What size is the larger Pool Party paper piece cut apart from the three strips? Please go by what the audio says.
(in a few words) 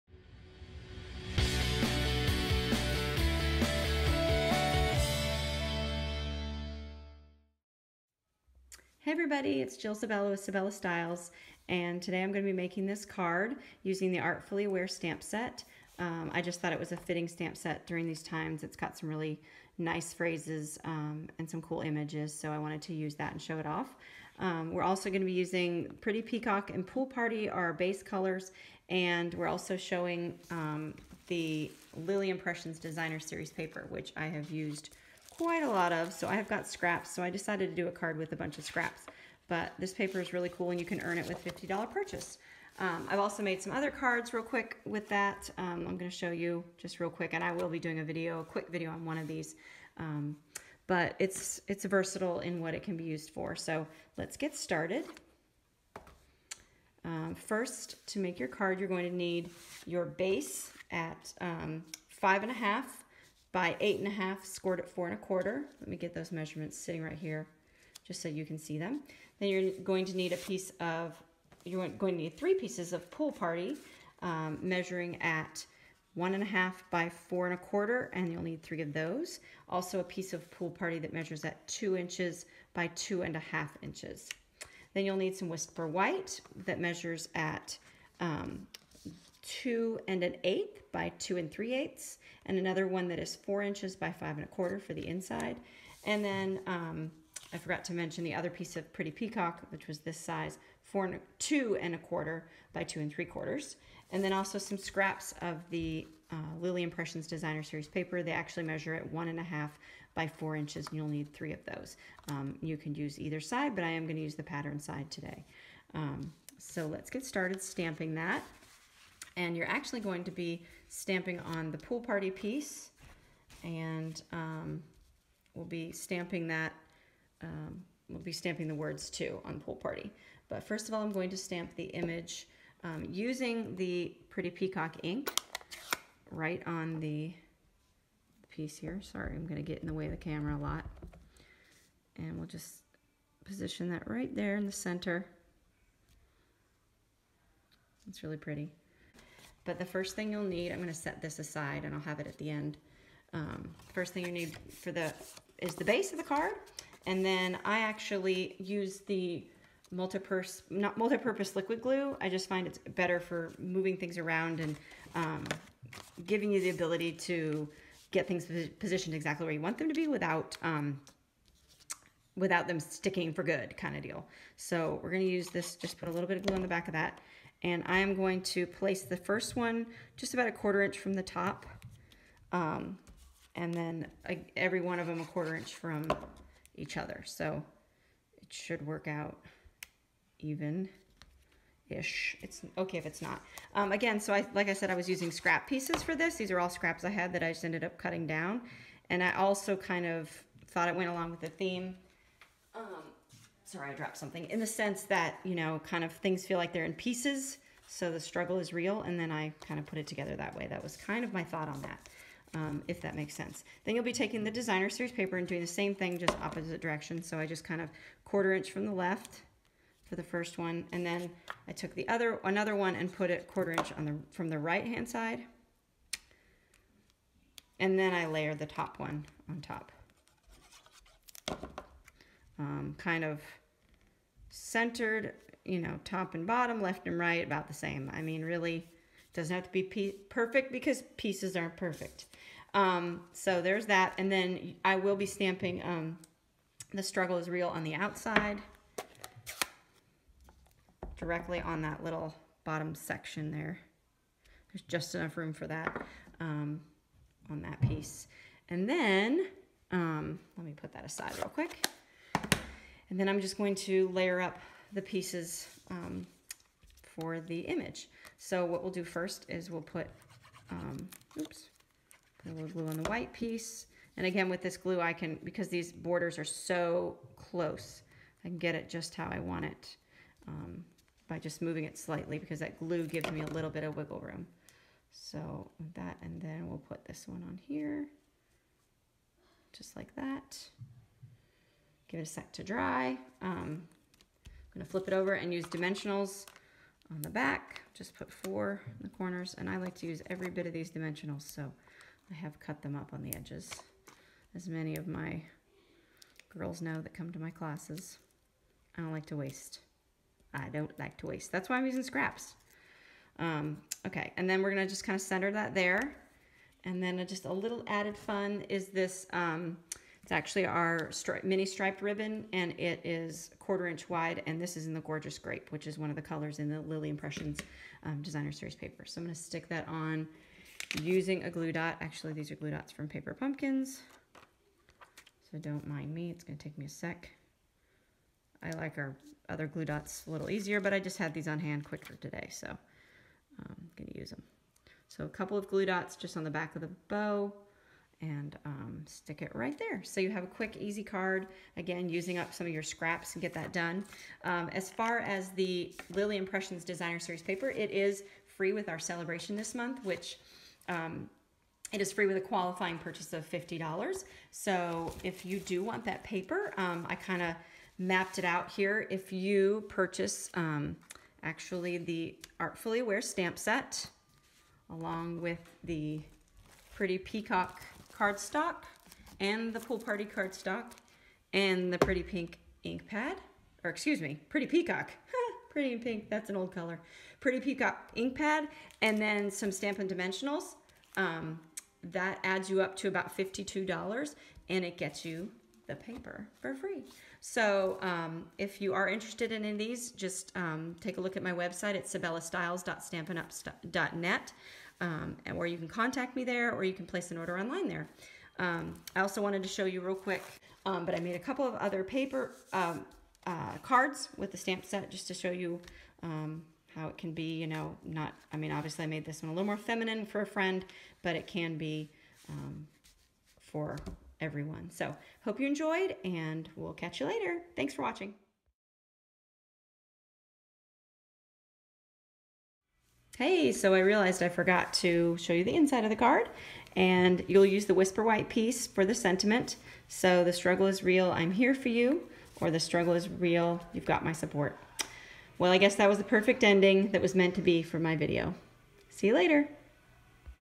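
2 by 2 1/2 inches.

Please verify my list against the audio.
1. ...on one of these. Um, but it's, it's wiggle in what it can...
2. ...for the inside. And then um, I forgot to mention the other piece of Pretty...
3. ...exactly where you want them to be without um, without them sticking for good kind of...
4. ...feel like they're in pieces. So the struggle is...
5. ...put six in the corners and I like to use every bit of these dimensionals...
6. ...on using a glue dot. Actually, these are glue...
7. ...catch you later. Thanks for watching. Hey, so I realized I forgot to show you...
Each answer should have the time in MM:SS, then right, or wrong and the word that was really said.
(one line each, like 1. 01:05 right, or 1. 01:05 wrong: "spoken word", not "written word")
1. 00:48 wrong: "versatile", not "wiggle"
2. 01:34 right
3. 02:49 right
4. 03:26 right
5. 04:58 wrong: "four", not "six"
6. 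05:29 right
7. 07:06 right.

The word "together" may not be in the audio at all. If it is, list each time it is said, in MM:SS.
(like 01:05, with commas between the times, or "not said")
03:30.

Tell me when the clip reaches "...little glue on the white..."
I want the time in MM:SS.
04:32.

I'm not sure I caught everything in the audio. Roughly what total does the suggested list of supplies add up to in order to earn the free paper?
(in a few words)
About $52.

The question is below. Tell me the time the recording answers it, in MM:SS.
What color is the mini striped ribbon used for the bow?
05:25.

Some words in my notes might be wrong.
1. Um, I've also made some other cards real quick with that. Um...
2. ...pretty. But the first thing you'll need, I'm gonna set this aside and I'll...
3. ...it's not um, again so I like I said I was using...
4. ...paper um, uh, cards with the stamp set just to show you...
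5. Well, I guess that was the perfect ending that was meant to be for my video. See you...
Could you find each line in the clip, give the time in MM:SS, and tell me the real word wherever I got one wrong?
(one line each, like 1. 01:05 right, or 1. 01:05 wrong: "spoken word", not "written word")
1. 00:42 right
2. 02:28 right
3. 03:13 right
4. 06:52 right
5. 07:25 right.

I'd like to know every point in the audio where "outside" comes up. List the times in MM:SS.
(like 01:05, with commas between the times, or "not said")
04:07.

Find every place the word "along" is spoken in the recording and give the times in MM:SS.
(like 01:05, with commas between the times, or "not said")
03:21, 06:14.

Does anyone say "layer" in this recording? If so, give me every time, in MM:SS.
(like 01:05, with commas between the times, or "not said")
03:48, 04:24.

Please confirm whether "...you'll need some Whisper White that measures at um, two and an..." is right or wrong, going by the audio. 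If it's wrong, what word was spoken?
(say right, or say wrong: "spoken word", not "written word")
right.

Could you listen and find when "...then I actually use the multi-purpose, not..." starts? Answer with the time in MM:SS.
02:37.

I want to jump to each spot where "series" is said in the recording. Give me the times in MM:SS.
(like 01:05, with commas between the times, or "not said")
00:33, 01:47, 03:34, 05:28, 05:57.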